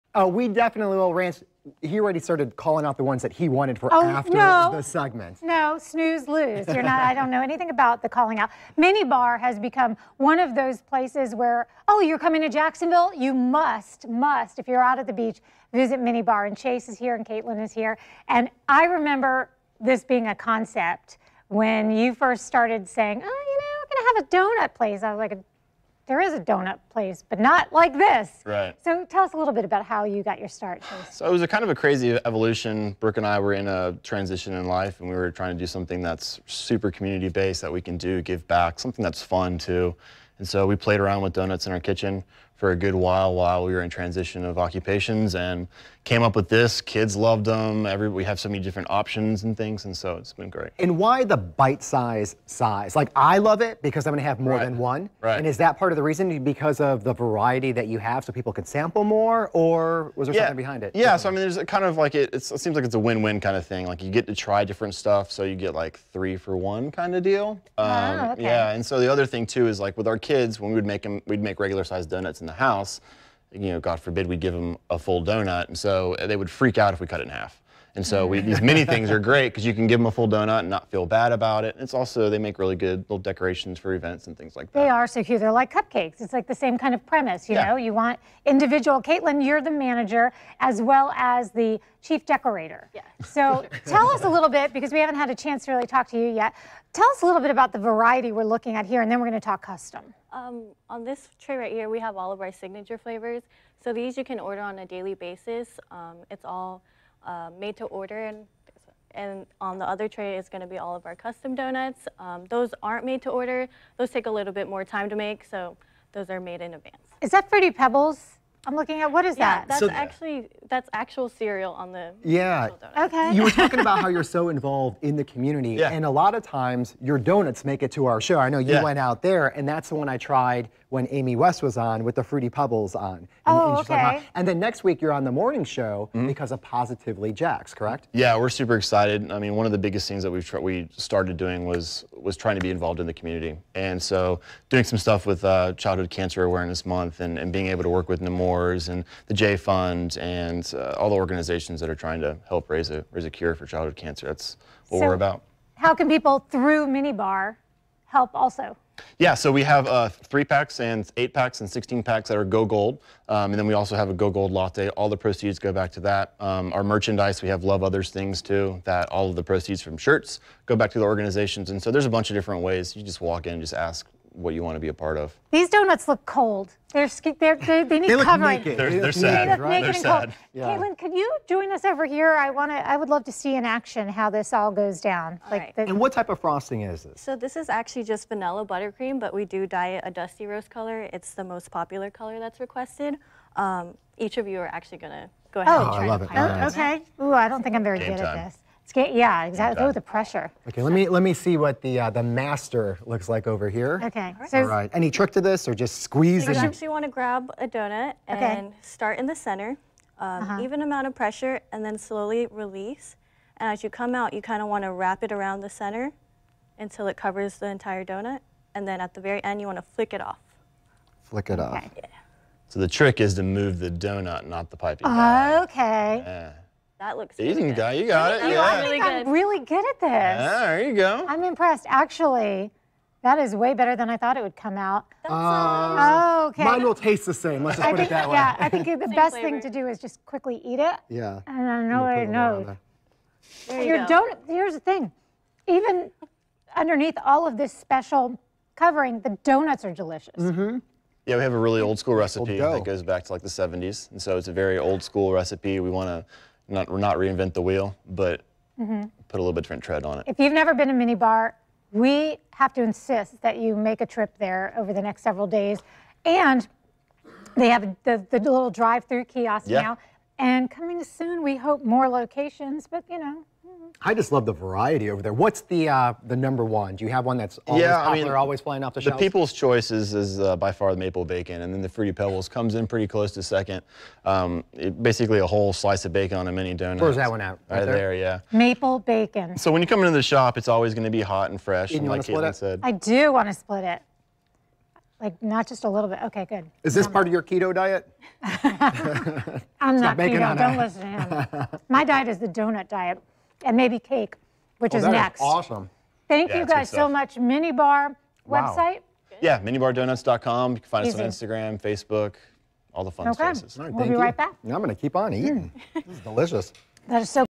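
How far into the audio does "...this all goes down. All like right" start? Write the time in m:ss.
3:04.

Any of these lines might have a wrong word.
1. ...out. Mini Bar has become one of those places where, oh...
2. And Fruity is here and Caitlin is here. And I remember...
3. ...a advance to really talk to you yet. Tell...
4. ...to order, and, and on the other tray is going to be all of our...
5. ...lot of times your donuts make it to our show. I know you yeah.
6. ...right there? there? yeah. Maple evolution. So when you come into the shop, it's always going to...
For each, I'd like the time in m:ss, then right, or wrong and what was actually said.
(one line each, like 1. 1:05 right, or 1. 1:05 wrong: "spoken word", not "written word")
1. 0:08 right
2. 0:16 wrong: "Chase", not "Fruity"
3. 1:35 wrong: "chance", not "advance"
4. 1:47 right
5. 2:06 right
6. 4:47 wrong: "bacon", not "evolution".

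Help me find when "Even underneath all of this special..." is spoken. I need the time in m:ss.
4:05.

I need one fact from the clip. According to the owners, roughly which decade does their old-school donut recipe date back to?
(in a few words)
the 70s.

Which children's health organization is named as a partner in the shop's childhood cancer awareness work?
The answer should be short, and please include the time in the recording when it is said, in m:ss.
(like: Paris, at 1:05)
Nemours, at 2:28.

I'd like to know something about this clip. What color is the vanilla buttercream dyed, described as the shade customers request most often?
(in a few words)
dusty rose.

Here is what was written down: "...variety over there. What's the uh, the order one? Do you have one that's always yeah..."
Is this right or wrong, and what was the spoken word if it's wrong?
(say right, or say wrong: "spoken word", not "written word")
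wrong: "number", not "order".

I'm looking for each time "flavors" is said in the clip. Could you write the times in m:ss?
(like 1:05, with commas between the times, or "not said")
1:42, 3:59.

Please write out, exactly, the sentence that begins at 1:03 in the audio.
Like, you get to try different stuff, so you get like three for one kind of deal.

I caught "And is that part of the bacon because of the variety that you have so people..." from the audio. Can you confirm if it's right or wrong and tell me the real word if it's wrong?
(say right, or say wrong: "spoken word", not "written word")
wrong: "reason", not "bacon".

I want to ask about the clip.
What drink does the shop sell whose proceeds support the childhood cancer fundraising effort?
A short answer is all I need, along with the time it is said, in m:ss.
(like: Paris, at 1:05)
Go Gold latte, at 2:44.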